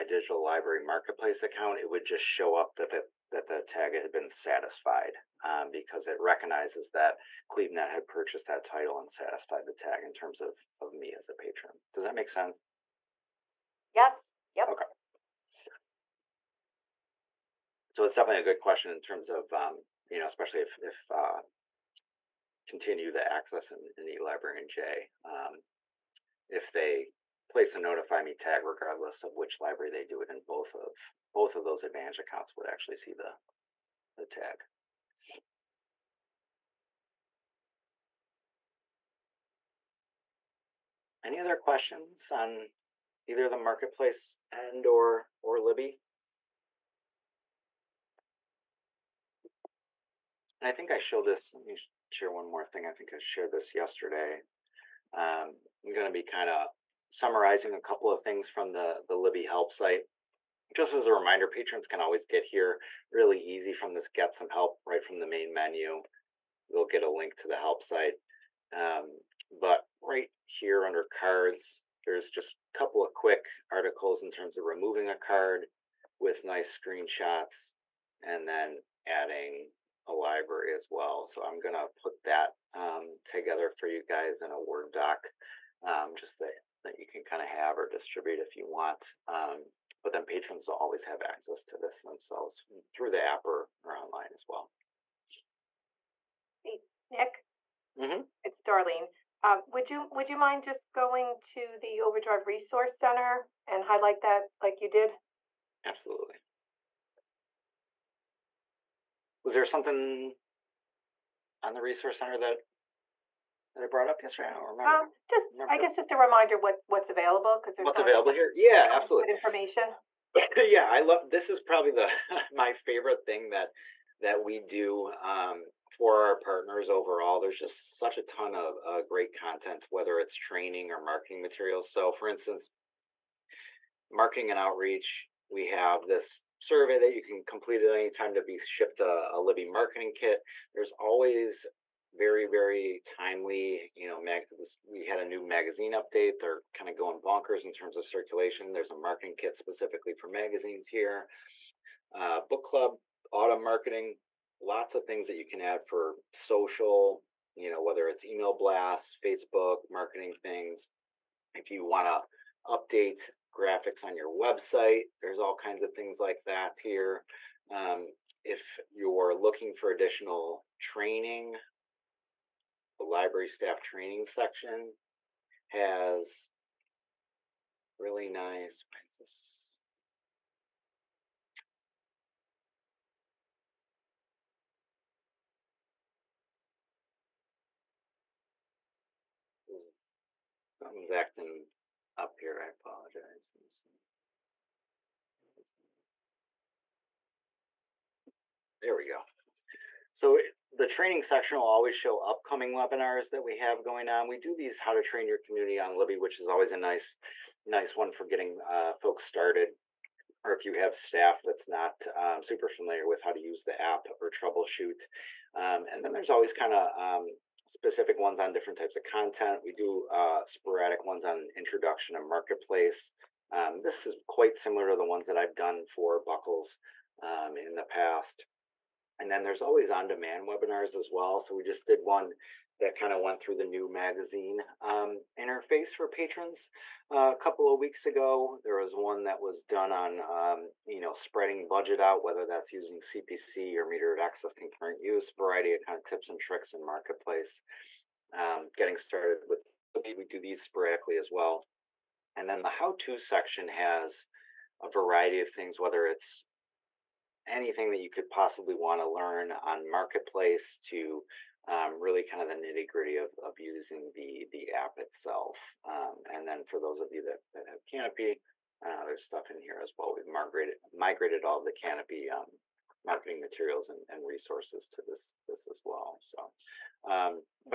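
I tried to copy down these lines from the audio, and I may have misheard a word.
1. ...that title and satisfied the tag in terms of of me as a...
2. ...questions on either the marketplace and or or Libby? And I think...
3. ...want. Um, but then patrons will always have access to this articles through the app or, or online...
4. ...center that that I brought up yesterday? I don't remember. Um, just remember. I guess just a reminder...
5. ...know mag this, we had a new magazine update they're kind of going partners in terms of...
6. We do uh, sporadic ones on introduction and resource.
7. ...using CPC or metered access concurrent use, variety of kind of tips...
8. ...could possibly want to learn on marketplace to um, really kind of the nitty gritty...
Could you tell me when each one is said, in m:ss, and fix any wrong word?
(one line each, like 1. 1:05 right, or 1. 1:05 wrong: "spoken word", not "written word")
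1. 0:08 right
2. 0:41 right
3. 1:28 wrong: "themselves", not "articles"
4. 1:52 right
5. 2:24 wrong: "bonkers", not "partners"
6. 3:39 wrong: "marketplace", not "resource"
7. 4:02 right
8. 4:18 right.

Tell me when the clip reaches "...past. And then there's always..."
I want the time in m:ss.
3:47.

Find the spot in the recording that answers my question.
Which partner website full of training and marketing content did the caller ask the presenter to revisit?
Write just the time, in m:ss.
1:42.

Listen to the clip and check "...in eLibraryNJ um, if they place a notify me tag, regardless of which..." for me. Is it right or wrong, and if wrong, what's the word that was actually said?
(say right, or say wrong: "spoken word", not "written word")
right.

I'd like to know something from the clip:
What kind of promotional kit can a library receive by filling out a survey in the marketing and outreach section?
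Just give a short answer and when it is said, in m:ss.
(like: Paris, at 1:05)
Libby marketing kit, at 2:19.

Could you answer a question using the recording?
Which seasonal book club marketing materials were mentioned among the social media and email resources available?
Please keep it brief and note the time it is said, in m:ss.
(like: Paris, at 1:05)
book club autumn, at 2:32.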